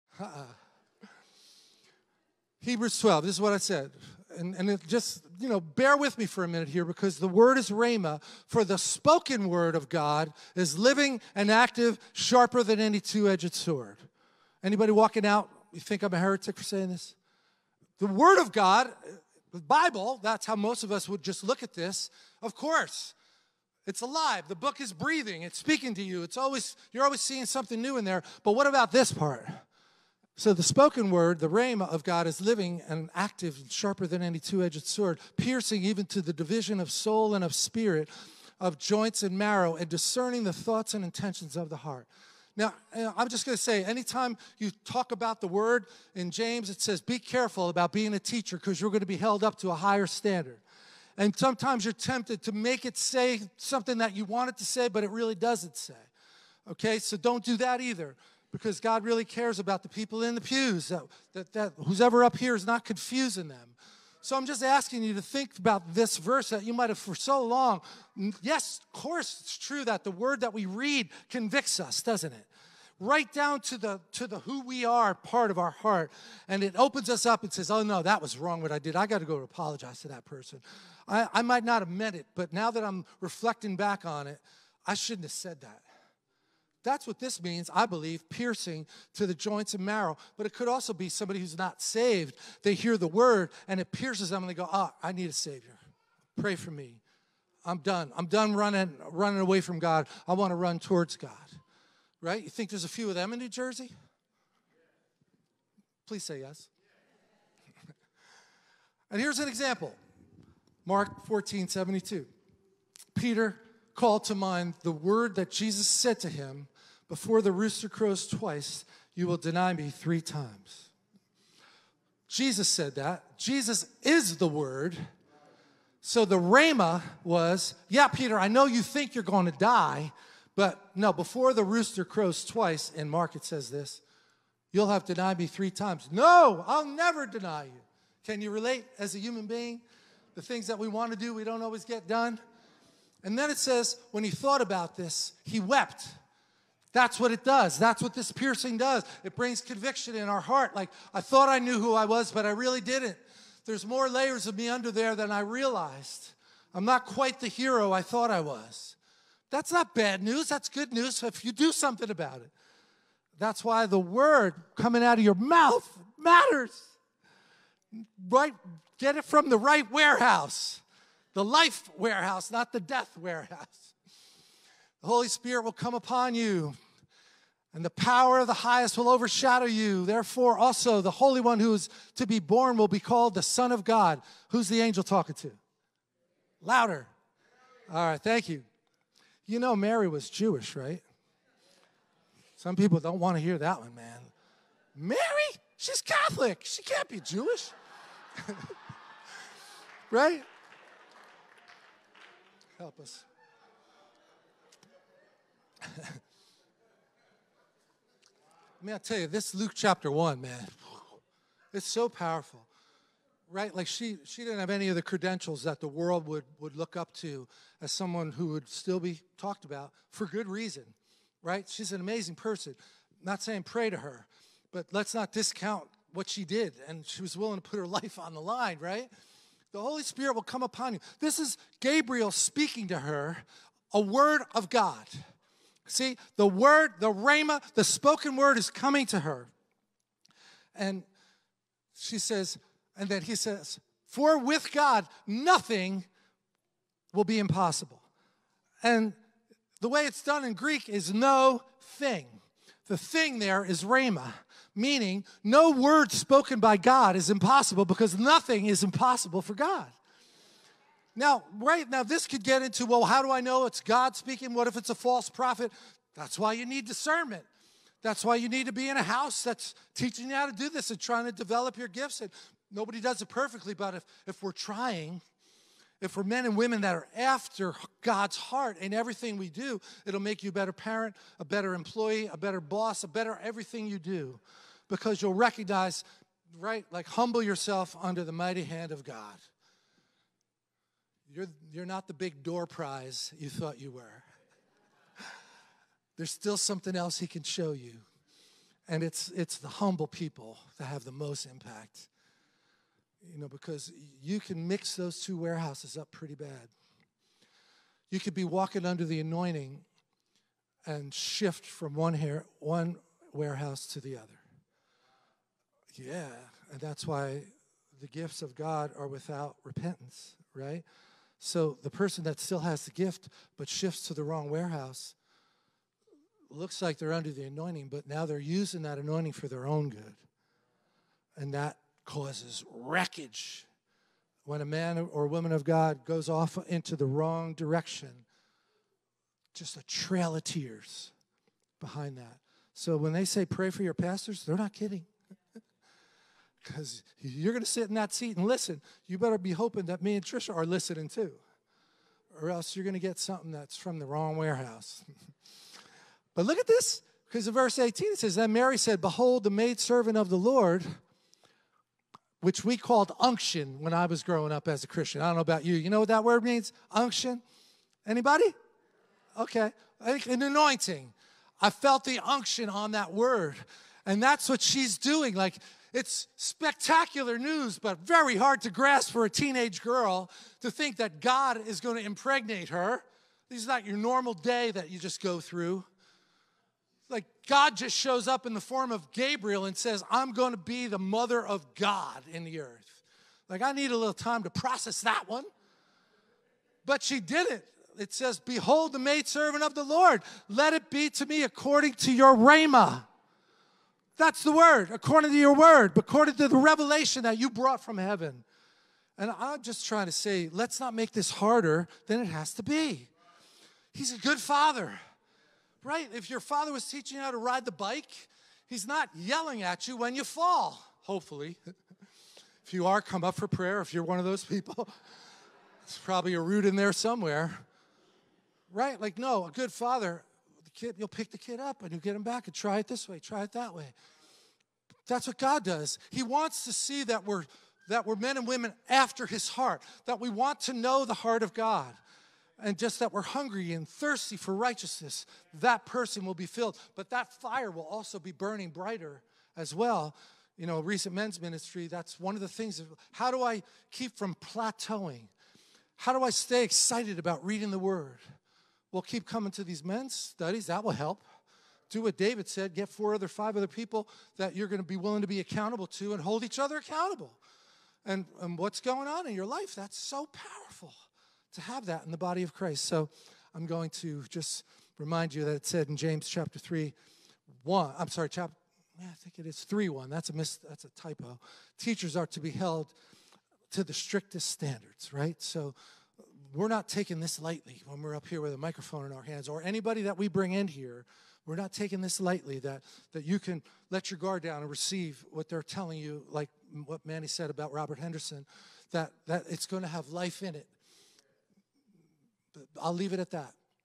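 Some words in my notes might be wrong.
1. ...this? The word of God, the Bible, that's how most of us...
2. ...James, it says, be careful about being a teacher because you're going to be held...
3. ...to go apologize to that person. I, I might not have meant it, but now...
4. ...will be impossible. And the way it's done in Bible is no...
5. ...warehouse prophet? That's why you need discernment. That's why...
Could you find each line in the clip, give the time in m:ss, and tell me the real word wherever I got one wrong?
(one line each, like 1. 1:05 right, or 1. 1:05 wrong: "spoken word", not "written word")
1. 0:16 right
2. 0:46 right
3. 1:19 right
4. 4:07 wrong: "Greek", not "Bible"
5. 4:24 wrong: "false", not "warehouse".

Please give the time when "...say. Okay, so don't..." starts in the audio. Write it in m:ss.
0:55.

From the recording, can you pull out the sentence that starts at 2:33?
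There's more layers of me under there than I realized.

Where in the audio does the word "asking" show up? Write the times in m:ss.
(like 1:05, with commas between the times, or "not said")
1:04.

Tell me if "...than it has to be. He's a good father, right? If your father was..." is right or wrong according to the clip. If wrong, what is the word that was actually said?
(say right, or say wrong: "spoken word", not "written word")
right.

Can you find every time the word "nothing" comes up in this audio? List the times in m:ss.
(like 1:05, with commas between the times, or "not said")
4:05, 4:18.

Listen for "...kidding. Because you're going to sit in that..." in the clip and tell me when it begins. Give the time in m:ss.
5:44.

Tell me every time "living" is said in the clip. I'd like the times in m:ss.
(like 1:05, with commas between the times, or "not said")
0:10, 0:32.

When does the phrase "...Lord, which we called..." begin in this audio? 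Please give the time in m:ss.
6:00.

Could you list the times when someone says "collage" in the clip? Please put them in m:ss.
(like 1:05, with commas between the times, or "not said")
not said.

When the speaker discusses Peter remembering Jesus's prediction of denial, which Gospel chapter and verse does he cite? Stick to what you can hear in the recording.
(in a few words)
Mark 14:72.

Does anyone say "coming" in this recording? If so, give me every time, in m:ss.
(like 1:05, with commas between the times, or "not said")
2:44, 3:58, 7:39.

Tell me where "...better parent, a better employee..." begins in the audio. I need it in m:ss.
4:40.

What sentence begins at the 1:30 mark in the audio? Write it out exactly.
But it could also be somebody who's not saved.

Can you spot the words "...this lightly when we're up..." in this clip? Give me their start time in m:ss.
8:07.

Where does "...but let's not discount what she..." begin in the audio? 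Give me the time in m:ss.
3:44.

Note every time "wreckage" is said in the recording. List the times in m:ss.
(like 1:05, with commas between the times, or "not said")
5:32.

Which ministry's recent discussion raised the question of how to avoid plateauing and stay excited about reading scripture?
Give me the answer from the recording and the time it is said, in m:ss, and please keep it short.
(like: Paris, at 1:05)
Men's ministry, at 7:31.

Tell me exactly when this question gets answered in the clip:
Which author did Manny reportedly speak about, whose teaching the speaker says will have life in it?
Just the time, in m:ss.
8:17.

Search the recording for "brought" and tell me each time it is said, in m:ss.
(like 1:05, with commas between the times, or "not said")
6:47.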